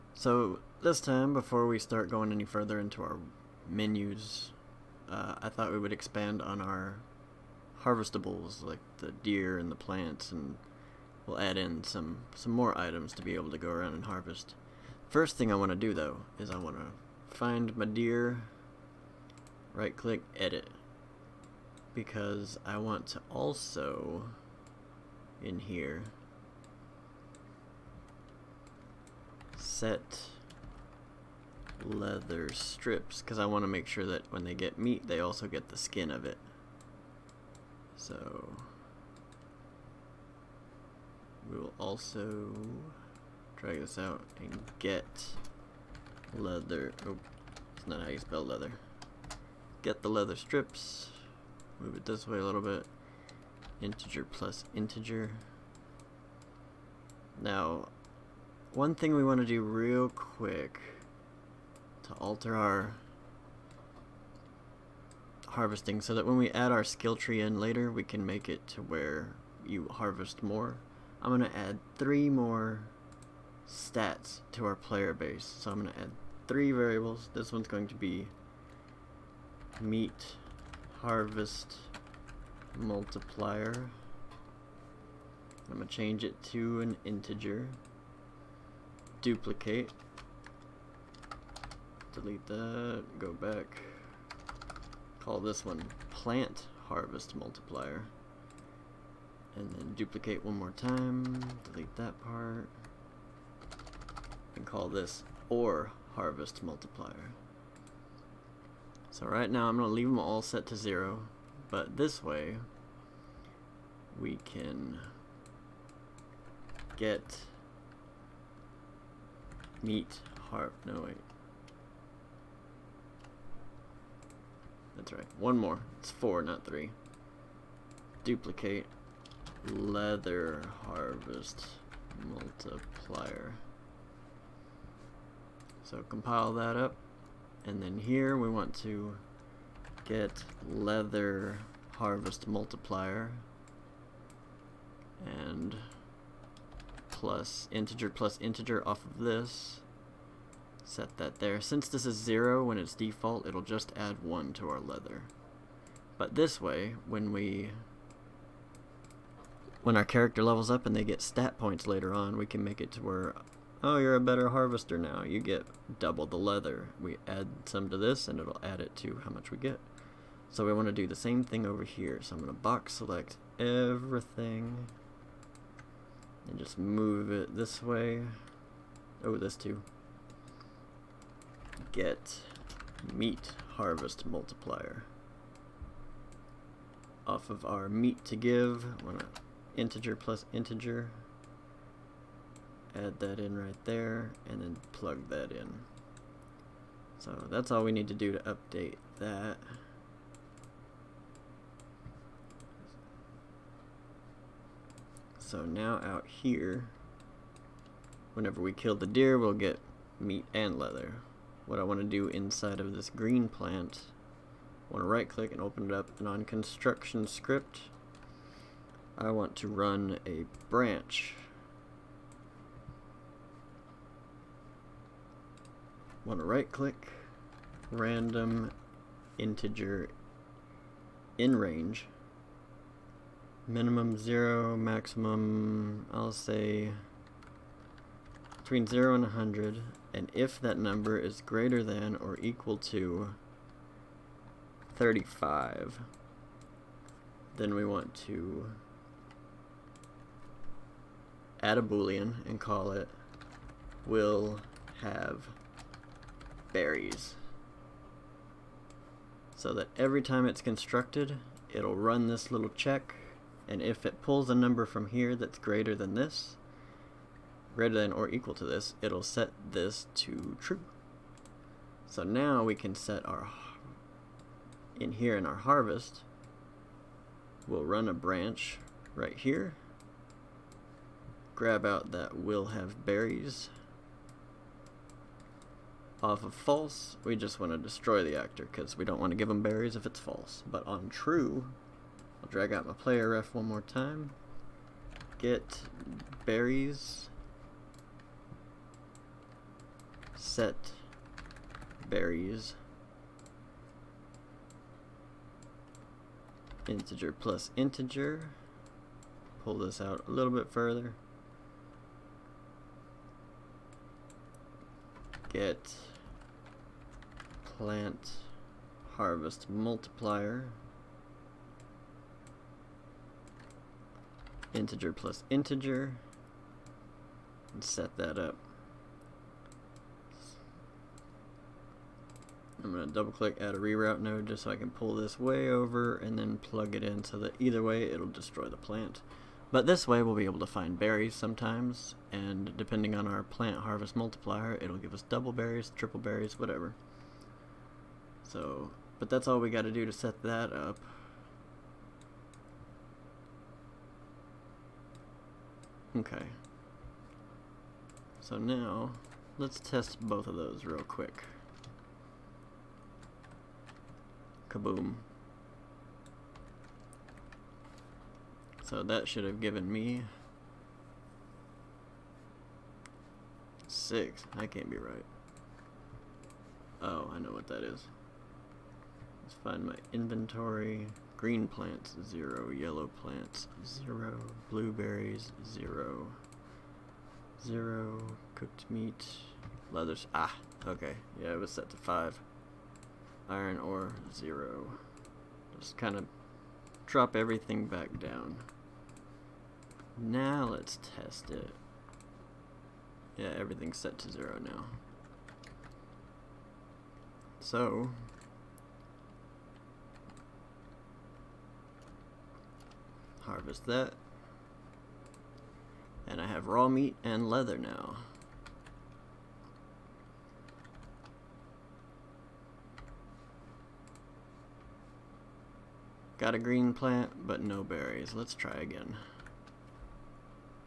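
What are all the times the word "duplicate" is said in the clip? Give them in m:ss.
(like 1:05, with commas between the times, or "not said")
1:29, 1:39, 2:08.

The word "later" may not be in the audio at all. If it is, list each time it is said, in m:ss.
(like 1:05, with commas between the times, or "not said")
1:07, 2:41.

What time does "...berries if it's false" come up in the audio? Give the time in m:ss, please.
4:49.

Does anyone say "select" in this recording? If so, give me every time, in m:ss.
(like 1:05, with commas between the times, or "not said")
2:52.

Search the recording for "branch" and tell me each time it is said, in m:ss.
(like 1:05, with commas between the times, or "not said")
3:40, 4:38.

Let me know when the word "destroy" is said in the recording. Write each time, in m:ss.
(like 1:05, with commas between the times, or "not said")
4:47, 5:38.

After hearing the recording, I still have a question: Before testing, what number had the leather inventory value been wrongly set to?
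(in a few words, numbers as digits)
5.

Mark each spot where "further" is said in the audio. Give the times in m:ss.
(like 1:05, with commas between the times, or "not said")
0:02, 5:10.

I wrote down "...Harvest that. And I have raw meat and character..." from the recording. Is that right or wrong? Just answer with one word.
wrong.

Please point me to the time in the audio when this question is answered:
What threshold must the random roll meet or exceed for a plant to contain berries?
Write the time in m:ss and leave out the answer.
4:04.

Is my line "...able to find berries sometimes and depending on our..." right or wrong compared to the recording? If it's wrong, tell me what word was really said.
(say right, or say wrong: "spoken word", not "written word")
right.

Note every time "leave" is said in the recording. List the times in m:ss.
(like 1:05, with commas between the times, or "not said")
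1:49.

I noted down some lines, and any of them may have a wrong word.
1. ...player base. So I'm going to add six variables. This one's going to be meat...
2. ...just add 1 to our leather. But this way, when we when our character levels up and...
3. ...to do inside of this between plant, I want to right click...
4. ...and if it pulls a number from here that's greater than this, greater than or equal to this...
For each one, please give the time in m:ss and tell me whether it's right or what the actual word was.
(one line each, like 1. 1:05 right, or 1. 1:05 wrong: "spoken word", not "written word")
1. 1:14 wrong: "three", not "six"
2. 2:33 right
3. 3:31 wrong: "green", not "between"
4. 4:23 right.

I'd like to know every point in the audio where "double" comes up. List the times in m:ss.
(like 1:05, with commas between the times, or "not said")
2:45, 5:33, 5:45.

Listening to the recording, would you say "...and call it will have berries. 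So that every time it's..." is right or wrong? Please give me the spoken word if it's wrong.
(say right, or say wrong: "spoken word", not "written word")
right.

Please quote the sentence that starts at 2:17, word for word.
And then here we want to get leather harvest multiplier.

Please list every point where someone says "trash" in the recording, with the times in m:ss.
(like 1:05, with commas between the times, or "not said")
not said.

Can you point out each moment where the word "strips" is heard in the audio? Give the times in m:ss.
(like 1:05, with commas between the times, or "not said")
0:32, 0:50.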